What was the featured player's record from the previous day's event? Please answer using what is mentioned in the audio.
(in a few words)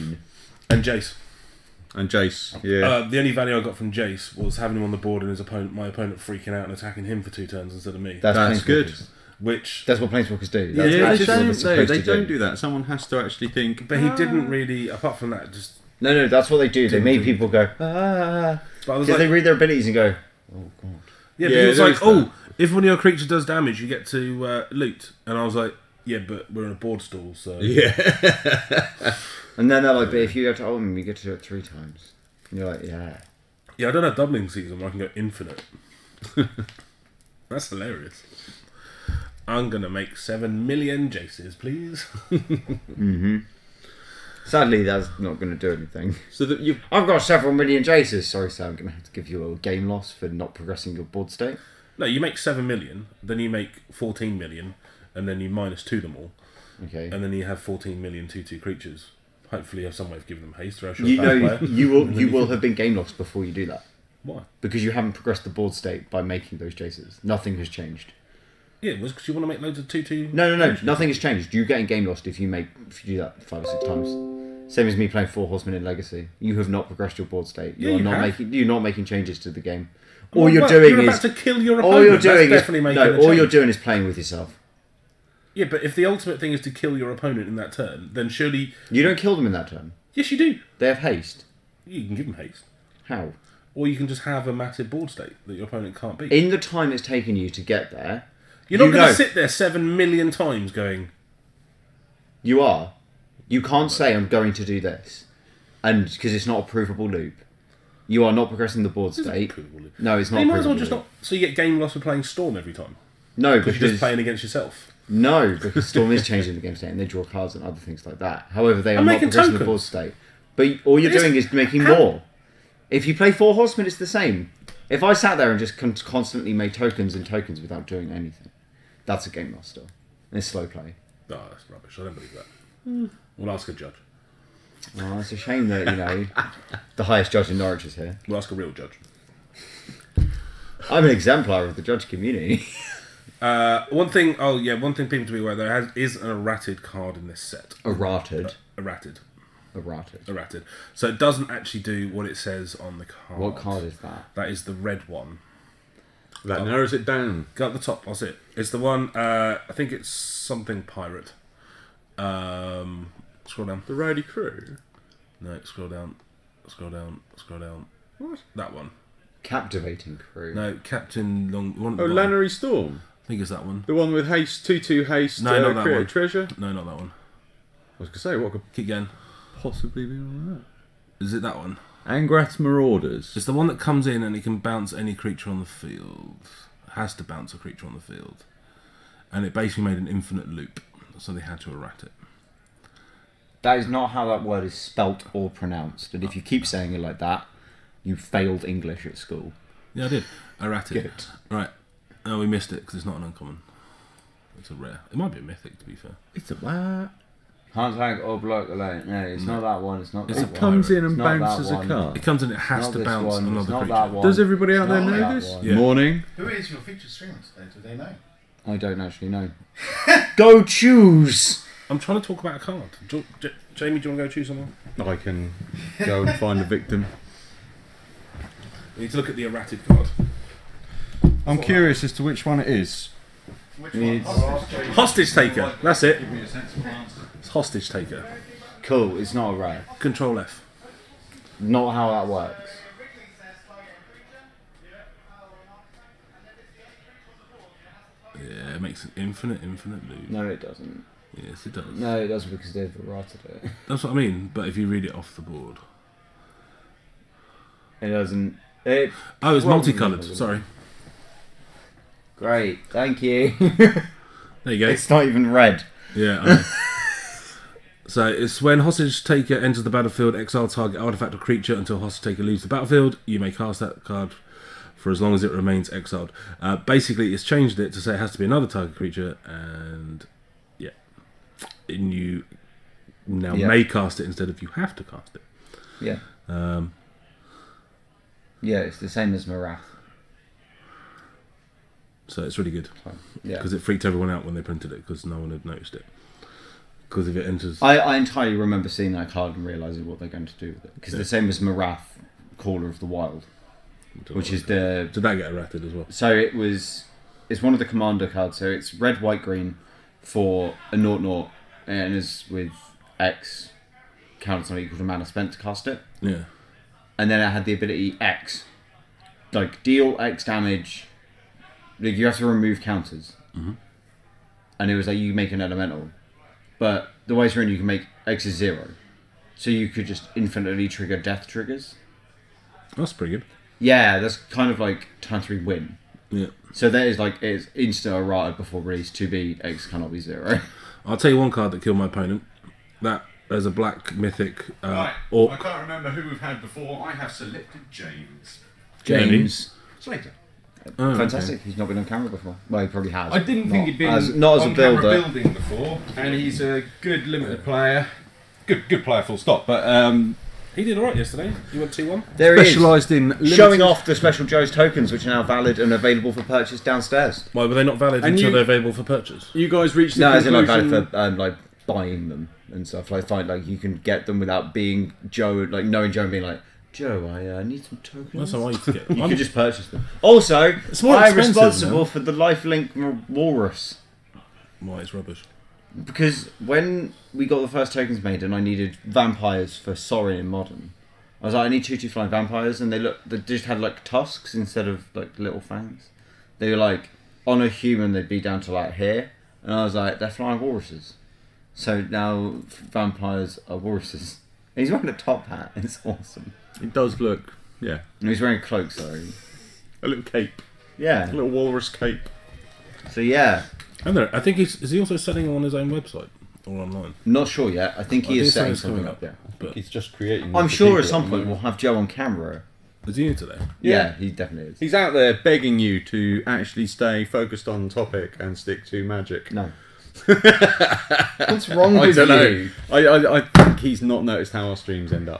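2-1.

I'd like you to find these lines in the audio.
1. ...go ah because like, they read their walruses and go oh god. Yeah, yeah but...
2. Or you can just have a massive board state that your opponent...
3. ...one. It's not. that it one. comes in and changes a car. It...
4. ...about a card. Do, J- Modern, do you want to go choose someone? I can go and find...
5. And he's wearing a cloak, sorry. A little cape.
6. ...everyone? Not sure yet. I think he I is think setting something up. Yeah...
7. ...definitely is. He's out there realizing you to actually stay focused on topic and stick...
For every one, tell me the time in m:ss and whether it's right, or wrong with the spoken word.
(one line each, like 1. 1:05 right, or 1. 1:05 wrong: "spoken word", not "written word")
1. 0:17 wrong: "abilities", not "walruses"
2. 1:33 right
3. 3:29 wrong: "bounces", not "changes"
4. 3:42 wrong: "Jamie", not "Modern"
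5. 6:48 right
6. 6:56 wrong: "online", not "everyone"
7. 7:04 wrong: "begging", not "realizing".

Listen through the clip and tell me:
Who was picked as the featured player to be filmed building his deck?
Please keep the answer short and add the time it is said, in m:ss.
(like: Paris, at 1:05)
James Slater, at 5:49.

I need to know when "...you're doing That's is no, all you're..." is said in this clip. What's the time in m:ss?
1:22.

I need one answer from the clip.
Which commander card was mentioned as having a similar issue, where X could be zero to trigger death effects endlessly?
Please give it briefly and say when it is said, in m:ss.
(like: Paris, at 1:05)
Marath, Caller of the Wild, at 5:01.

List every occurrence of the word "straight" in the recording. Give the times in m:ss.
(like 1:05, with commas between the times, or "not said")
not said.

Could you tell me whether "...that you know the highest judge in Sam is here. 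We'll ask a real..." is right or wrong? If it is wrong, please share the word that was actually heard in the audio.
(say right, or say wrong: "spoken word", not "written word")
wrong: "Norwich", not "Sam".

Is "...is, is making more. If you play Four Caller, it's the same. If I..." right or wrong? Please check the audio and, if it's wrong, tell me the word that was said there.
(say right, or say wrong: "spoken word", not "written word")
wrong: "Horsemen", not "Caller".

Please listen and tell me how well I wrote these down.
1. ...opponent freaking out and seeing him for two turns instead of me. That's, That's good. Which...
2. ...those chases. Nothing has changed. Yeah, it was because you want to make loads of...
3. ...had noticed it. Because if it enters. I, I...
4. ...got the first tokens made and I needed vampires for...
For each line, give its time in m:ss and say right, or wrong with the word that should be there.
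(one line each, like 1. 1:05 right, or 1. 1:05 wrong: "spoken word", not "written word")
1. 0:05 wrong: "attacking", not "seeing"
2. 1:06 right
3. 4:55 right
4. 6:27 right.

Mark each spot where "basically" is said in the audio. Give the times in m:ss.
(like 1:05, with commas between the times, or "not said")
3:09, 4:36.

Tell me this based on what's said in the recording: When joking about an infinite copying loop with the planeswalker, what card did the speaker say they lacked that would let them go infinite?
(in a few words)
Doubling Season.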